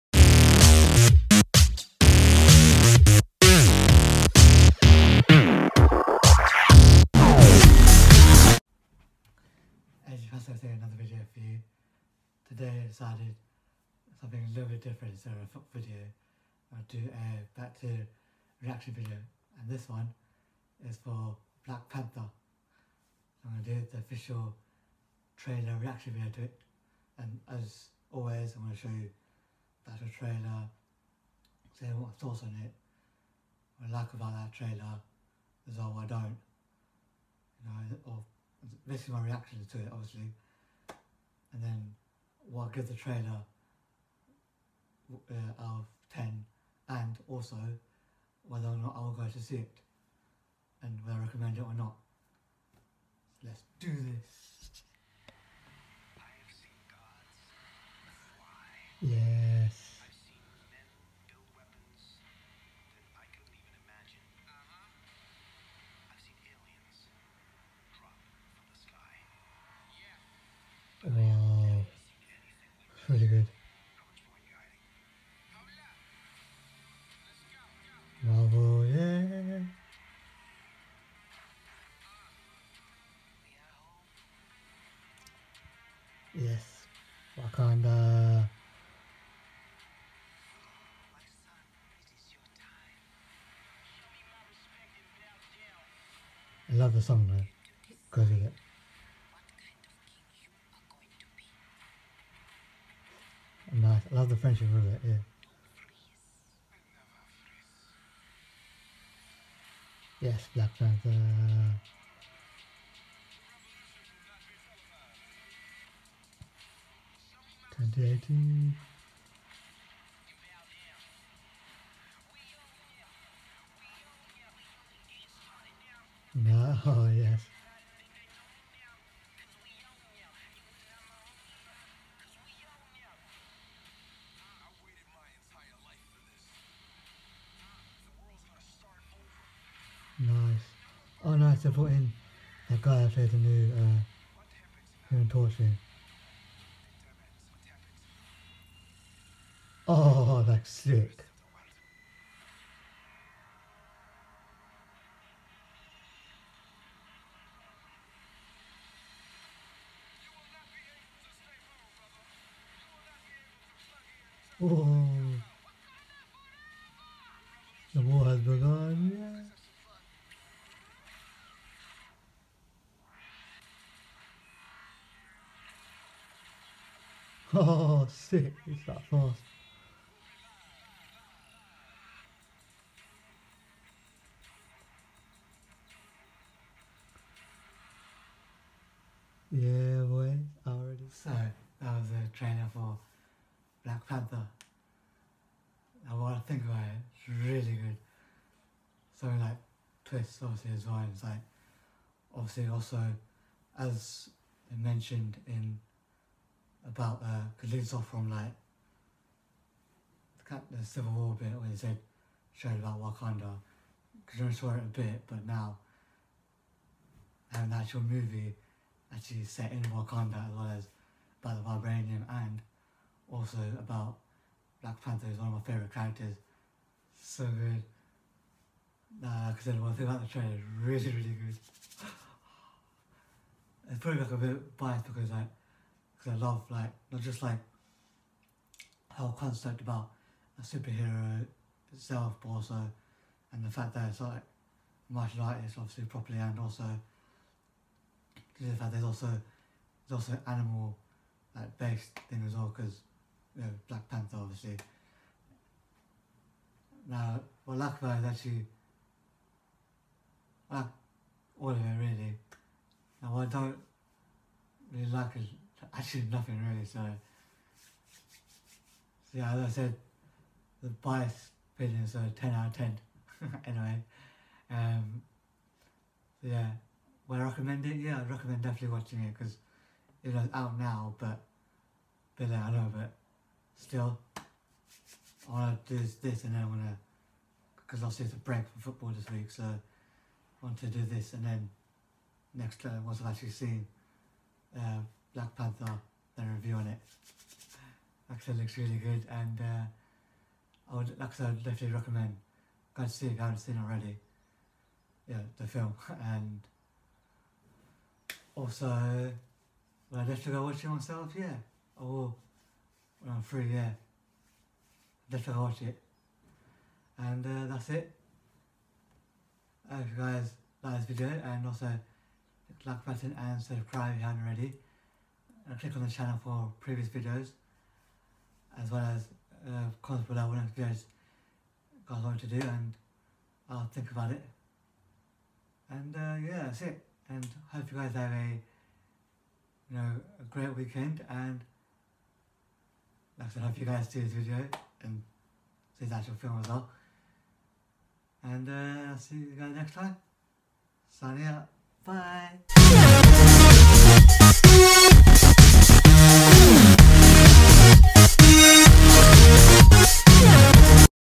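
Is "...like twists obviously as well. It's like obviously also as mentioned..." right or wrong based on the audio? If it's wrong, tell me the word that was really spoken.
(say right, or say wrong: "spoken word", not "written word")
right.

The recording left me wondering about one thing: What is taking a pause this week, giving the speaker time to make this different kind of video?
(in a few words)
football.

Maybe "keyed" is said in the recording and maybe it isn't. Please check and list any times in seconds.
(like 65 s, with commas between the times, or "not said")
not said.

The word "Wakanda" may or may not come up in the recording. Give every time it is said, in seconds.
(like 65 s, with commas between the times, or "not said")
213 s, 219 s.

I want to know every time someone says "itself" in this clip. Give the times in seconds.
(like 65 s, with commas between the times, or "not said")
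241 s.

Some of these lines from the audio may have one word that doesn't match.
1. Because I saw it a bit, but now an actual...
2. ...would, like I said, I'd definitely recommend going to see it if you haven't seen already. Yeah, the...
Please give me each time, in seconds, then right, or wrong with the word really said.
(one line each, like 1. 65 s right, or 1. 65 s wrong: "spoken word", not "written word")
1. 214 s right
2. 300 s right.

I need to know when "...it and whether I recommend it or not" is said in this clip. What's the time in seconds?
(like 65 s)
49 s.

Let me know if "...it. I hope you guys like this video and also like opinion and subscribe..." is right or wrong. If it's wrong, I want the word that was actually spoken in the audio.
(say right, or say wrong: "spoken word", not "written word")
wrong: "button", not "opinion".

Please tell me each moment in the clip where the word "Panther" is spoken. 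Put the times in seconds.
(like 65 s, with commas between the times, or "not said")
21 s, 110 s, 194 s, 225 s, 254 s, 295 s.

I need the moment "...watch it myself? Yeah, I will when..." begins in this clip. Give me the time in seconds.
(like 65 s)
310 s.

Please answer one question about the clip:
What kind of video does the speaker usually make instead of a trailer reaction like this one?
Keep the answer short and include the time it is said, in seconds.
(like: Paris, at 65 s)
foot video, at 15 s.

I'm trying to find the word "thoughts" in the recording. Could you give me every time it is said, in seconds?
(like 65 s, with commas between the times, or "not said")
32 s.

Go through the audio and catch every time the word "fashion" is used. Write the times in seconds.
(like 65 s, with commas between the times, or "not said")
not said.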